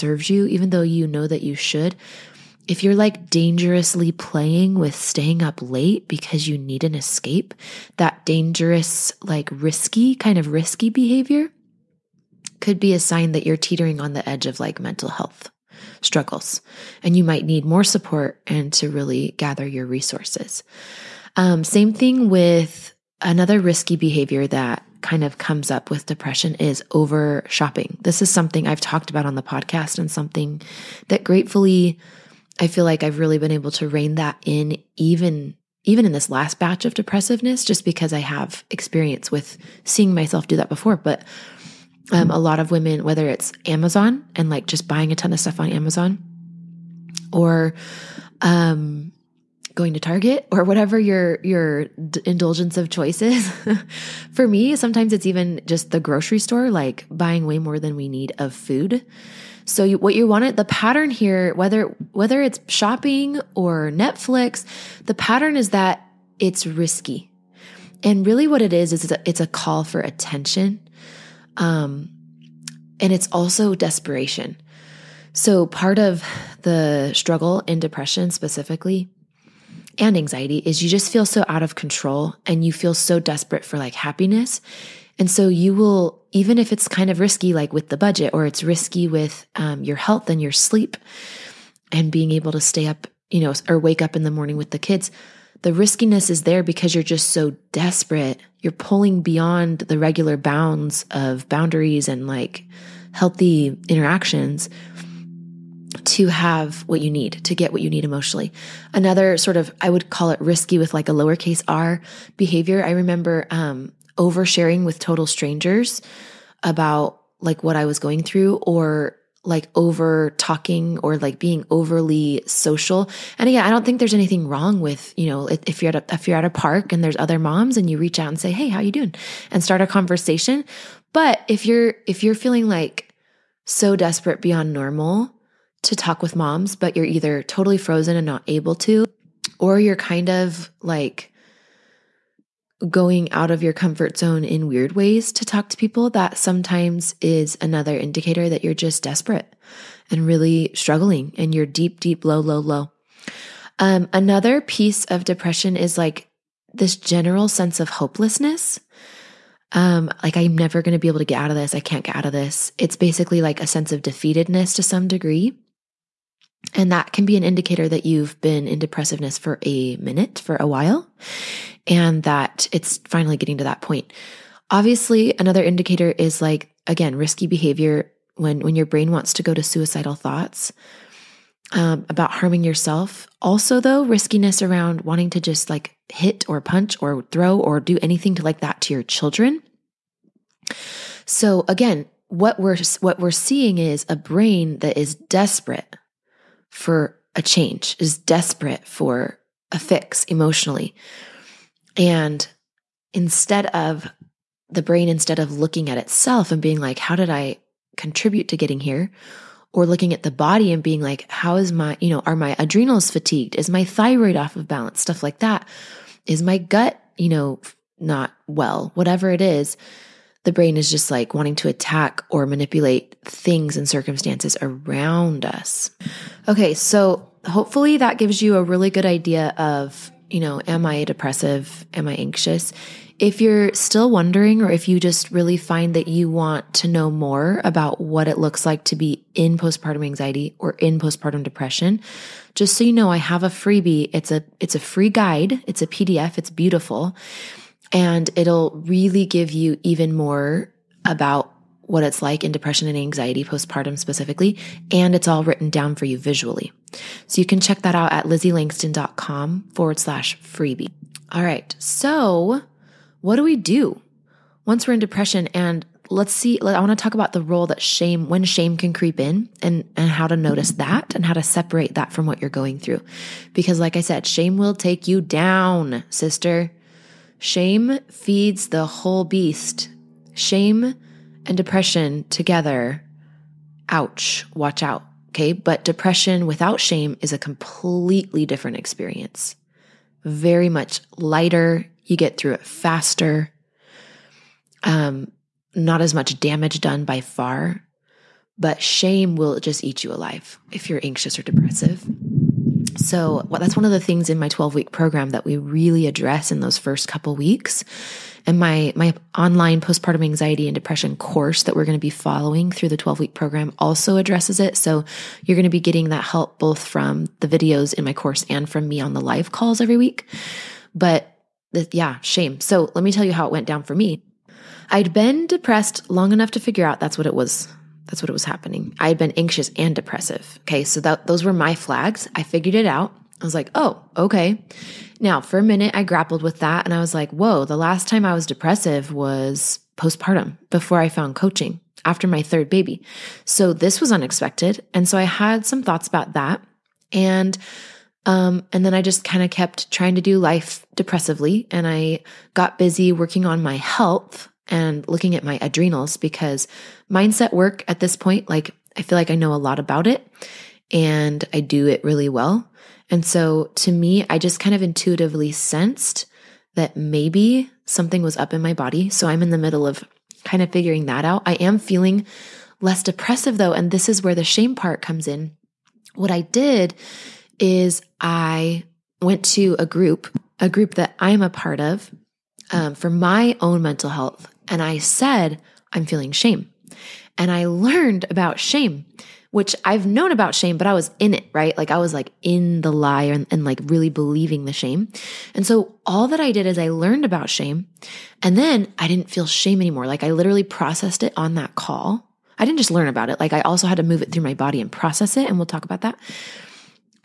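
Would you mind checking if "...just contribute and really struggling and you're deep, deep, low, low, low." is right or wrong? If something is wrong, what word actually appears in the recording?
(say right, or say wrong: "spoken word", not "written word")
wrong: "desperate", not "contribute".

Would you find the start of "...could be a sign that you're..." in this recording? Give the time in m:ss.
0:12.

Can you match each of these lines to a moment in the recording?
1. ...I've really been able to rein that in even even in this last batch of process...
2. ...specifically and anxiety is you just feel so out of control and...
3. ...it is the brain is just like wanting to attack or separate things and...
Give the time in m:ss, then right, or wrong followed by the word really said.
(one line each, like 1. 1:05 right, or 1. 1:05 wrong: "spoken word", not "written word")
1. 0:33 wrong: "depressiveness", not "process"
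2. 1:18 right
3. 3:39 wrong: "manipulate", not "separate".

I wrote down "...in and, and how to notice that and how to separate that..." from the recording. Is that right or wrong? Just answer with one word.
right.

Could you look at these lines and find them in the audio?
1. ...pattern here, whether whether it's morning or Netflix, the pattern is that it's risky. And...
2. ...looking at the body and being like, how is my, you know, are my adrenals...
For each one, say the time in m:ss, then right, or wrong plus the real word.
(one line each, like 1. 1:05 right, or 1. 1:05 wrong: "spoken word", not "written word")
1. 1:00 wrong: "shopping", not "morning"
2. 3:29 right.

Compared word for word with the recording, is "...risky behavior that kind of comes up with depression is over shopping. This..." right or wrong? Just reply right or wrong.
right.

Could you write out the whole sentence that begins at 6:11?
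I am feeling less depressive though.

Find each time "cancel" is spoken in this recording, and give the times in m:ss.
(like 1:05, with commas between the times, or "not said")
not said.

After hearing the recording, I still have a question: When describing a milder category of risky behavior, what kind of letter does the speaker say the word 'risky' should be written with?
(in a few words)
A lowercase r.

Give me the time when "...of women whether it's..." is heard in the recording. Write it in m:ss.
0:42.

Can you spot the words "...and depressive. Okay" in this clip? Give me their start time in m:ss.
5:29.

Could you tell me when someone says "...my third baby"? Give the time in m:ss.
5:42.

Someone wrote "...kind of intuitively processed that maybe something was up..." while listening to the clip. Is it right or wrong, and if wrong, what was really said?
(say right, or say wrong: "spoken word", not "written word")
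wrong: "sensed", not "processed".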